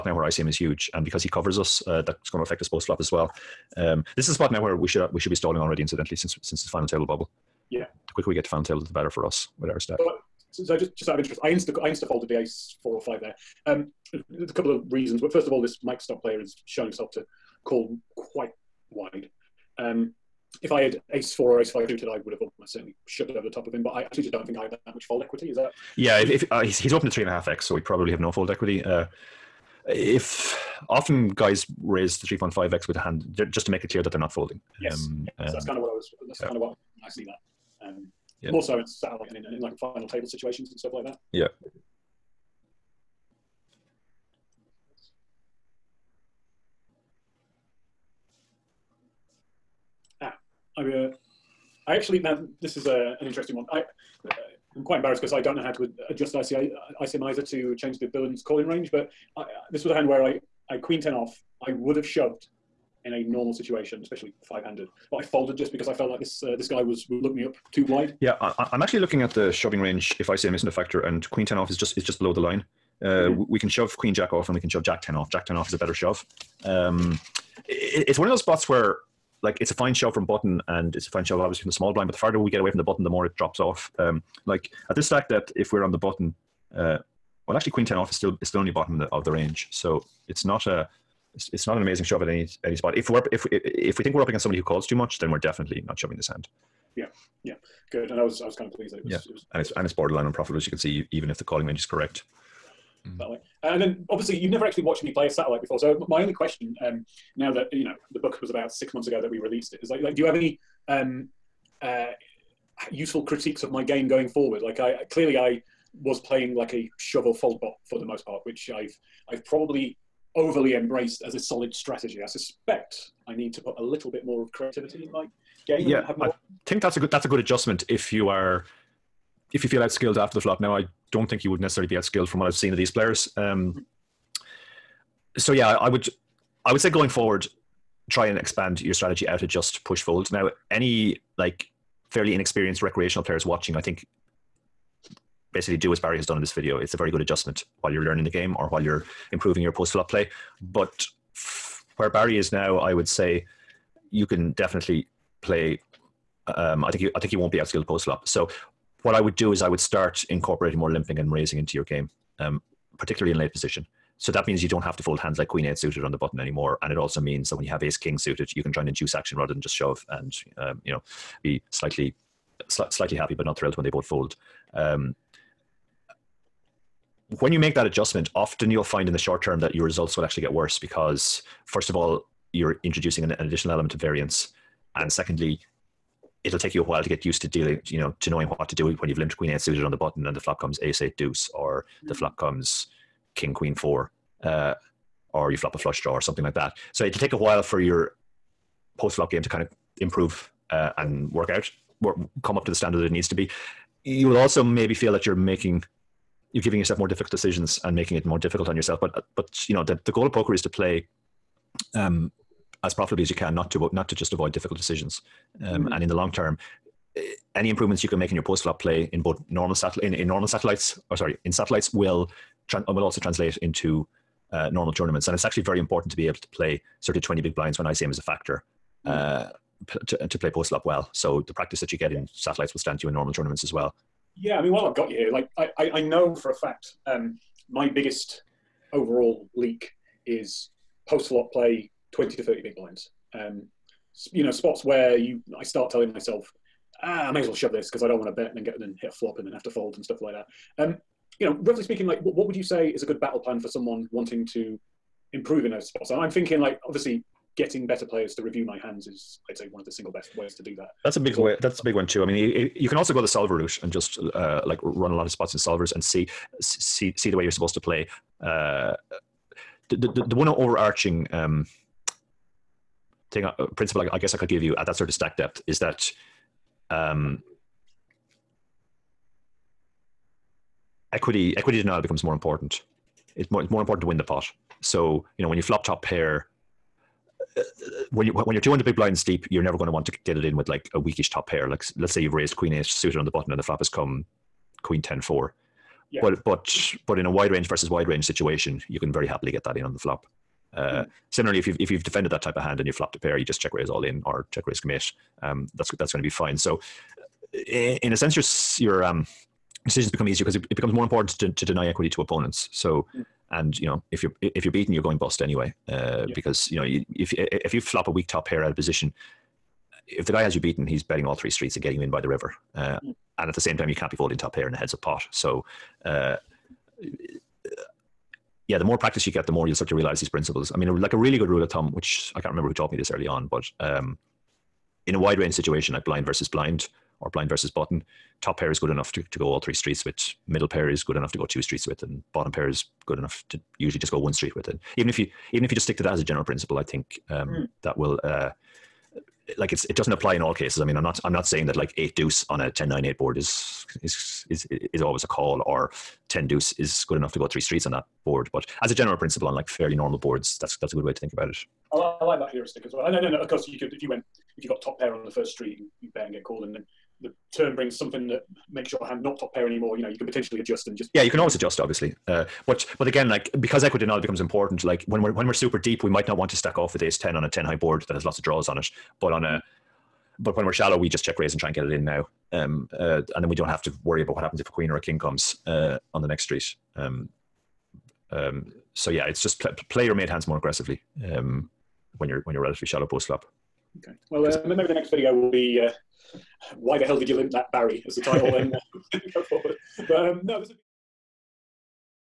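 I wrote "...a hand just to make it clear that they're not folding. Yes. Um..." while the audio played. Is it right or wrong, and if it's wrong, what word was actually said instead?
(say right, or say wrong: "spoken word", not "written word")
right.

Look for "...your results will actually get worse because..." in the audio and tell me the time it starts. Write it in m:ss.
2:59.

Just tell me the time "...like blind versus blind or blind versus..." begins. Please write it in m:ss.
5:35.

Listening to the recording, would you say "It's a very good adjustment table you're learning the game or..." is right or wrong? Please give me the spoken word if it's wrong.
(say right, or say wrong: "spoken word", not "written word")
wrong: "while", not "table".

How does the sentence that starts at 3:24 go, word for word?
You will also maybe feel that you're making, you're giving yourself more difficult decisions and making it more difficult on yourself.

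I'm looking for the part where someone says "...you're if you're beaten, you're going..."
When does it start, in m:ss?
5:14.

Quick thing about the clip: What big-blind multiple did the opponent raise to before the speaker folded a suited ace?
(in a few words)
3.5x.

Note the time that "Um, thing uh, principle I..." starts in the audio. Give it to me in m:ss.
4:31.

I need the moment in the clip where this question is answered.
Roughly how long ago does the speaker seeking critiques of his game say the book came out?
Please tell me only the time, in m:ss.
1:48.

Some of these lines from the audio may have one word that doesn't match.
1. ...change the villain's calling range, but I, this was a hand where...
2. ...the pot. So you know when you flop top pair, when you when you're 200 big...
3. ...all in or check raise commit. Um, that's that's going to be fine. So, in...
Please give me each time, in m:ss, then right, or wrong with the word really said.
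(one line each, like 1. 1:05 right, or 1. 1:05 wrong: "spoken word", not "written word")
1. 0:57 right
2. 4:44 right
3. 5:03 right.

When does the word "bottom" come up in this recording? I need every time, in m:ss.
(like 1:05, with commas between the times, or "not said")
1:28, 5:42.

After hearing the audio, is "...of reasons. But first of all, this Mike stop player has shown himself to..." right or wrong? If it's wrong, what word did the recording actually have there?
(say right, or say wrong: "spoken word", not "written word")
right.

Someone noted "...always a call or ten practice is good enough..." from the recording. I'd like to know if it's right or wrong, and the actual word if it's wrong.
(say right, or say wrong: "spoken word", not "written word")
wrong: "deuce", not "practice".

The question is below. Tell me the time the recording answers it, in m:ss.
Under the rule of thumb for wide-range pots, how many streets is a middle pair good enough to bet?
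5:41.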